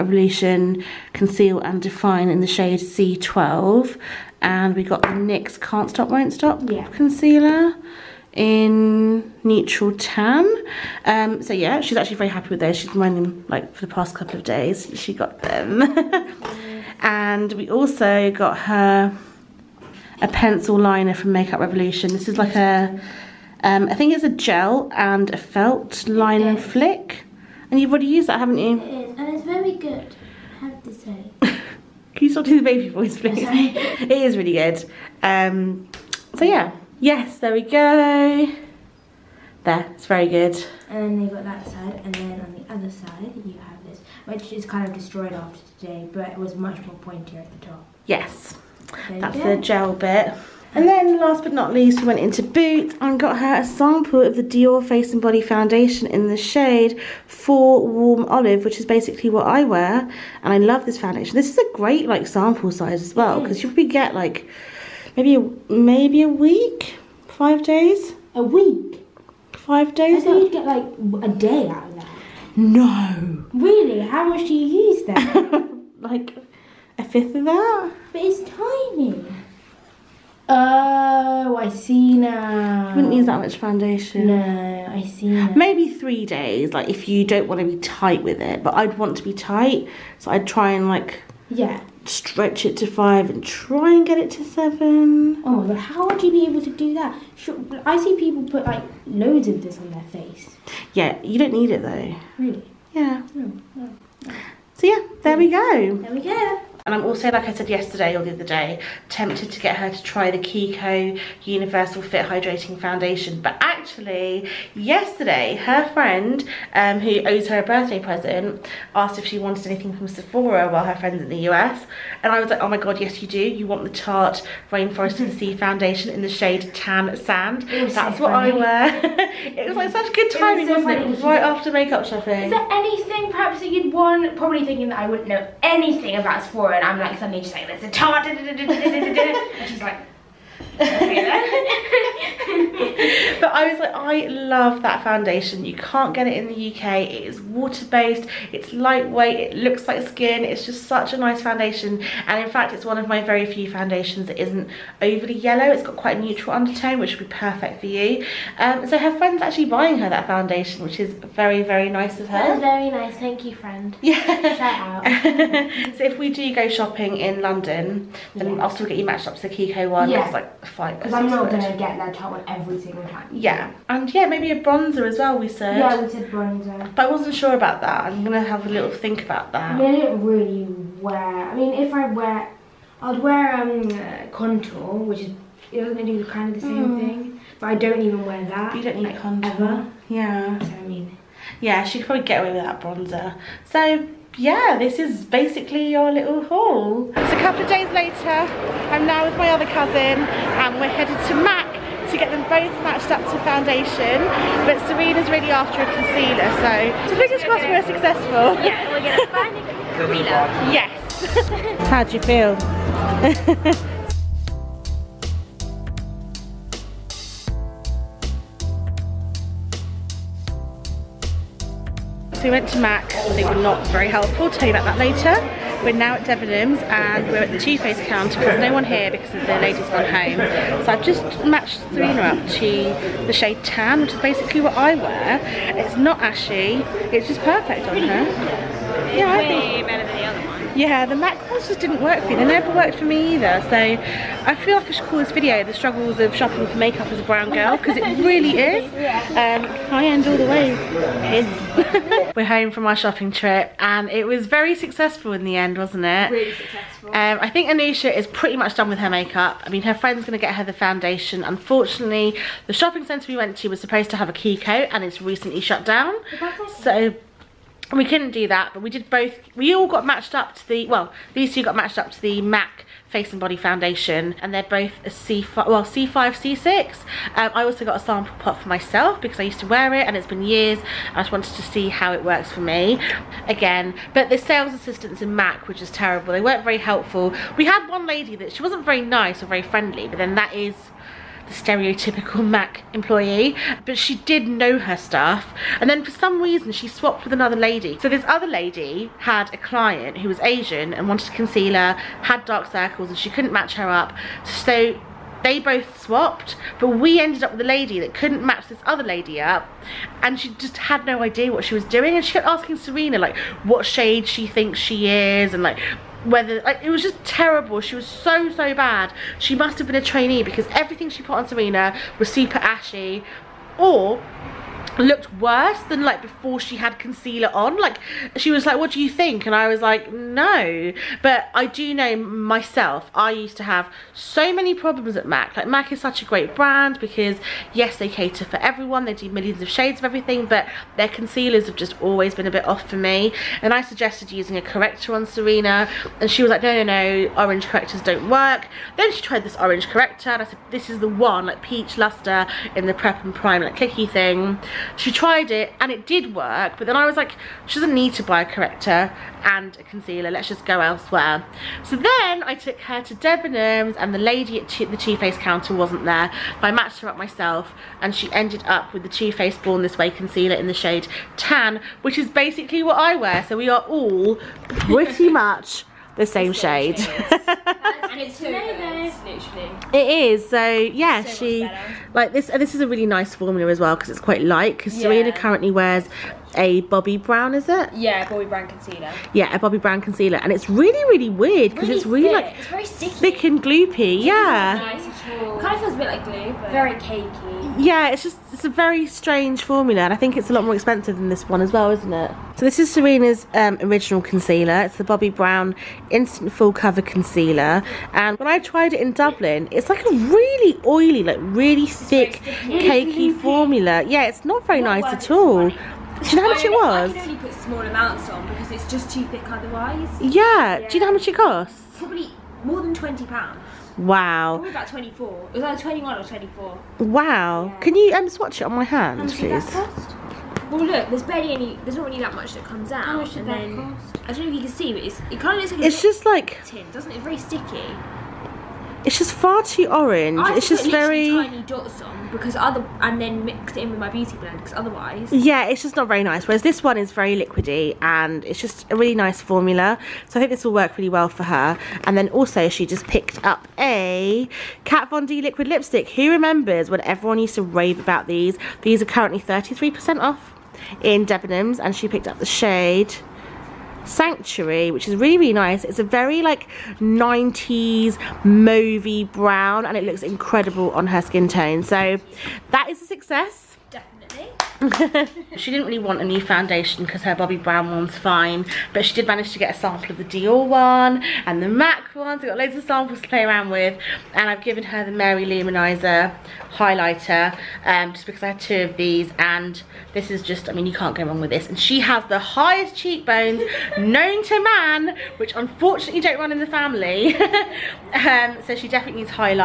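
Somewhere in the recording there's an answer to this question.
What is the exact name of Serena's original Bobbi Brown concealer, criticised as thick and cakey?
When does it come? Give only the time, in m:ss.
6:46.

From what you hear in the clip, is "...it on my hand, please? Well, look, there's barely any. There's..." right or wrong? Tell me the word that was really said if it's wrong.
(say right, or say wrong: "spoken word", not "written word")
right.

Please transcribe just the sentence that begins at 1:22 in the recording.
You wouldn't use that much foundation.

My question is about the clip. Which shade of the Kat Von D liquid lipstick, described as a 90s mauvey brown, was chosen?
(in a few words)
Sanctuary.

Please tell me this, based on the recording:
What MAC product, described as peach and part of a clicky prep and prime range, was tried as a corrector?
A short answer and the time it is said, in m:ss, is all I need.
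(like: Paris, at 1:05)
Peach Luster, at 5:51.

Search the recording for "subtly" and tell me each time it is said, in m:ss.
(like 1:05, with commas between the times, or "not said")
not said.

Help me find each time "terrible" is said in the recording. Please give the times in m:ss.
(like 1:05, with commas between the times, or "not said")
4:45, 5:17.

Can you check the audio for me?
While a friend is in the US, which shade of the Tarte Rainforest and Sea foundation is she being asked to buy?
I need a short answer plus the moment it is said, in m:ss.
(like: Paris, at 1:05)
Tan Sand, at 2:06.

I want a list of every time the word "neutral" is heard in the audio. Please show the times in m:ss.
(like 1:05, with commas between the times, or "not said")
0:09, 2:36.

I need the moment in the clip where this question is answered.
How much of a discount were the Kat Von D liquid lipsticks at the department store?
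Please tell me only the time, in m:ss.
7:39.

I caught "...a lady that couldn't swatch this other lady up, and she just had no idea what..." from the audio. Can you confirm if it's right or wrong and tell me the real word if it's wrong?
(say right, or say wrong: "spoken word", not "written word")
wrong: "match", not "swatch".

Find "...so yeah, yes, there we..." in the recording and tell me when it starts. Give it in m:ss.
0:36.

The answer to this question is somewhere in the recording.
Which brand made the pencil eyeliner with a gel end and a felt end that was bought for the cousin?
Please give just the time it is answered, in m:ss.
0:21.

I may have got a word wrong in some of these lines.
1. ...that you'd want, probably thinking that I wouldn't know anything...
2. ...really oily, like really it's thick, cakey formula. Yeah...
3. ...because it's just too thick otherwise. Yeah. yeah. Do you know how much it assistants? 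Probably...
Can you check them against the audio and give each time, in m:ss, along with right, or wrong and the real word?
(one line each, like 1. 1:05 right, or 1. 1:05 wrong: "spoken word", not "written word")
1. 2:13 right
2. 6:50 right
3. 6:58 wrong: "costs", not "assistants".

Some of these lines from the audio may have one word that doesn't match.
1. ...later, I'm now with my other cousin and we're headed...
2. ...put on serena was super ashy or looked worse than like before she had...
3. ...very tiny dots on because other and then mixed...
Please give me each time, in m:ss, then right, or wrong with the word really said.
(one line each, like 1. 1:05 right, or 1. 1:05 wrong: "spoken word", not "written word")
1. 3:17 right
2. 5:21 right
3. 7:20 right.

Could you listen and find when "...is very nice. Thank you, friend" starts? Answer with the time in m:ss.
2:42.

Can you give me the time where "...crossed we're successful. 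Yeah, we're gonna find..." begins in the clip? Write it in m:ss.
3:27.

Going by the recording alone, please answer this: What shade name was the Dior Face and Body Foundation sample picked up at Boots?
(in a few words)
Warm Olive.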